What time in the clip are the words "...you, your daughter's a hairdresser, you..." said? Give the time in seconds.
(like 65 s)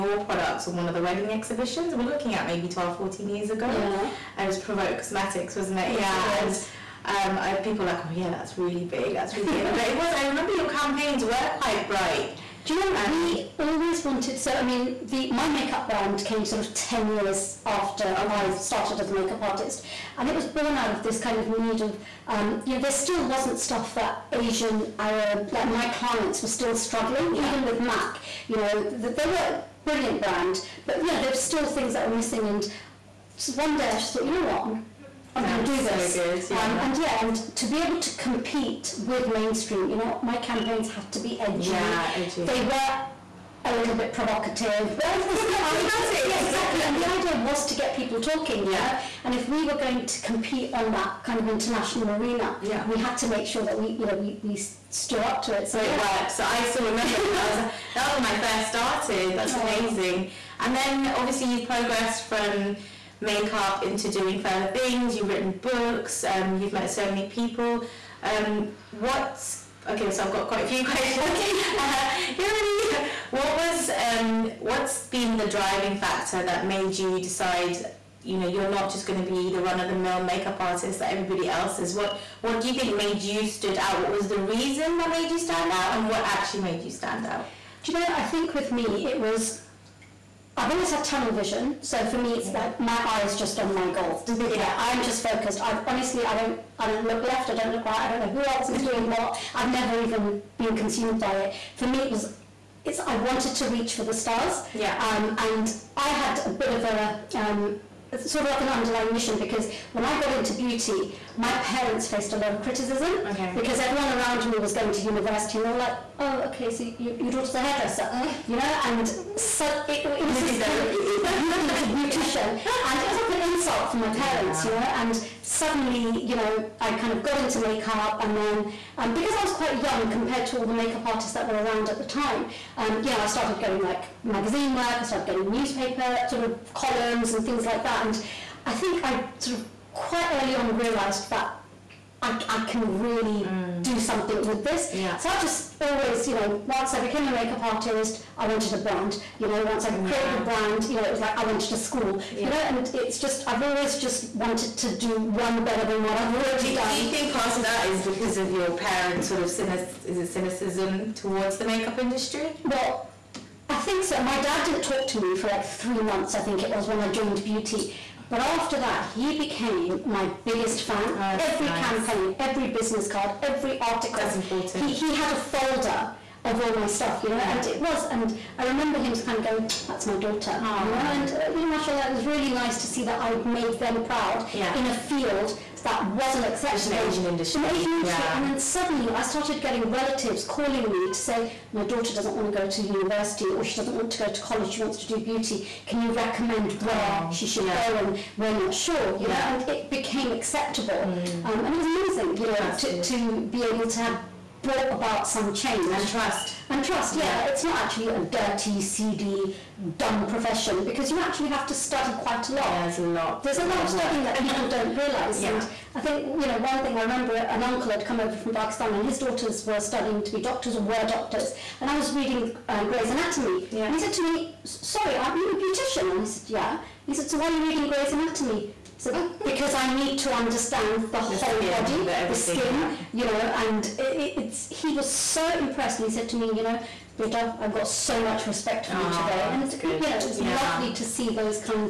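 116 s.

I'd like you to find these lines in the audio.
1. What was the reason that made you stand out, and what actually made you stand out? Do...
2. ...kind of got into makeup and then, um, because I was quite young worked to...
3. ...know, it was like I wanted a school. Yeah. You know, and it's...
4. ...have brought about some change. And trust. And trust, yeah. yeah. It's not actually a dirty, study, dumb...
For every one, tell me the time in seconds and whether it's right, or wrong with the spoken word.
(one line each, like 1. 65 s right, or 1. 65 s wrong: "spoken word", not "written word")
1. 84 s right
2. 126 s wrong: "compared", not "worked"
3. 151 s right
4. 203 s wrong: "seedy", not "study".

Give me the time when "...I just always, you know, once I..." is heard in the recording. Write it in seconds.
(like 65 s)
145 s.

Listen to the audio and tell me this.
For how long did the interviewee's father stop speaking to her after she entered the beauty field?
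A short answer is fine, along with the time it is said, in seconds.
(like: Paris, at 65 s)
3 months, at 165 s.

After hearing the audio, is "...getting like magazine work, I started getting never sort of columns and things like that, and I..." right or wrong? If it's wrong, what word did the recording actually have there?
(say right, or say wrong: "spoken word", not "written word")
wrong: "newspaper", not "never".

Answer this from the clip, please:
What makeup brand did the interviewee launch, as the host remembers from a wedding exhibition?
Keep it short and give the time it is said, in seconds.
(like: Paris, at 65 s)
Provoke Cosmetics, at 4 s.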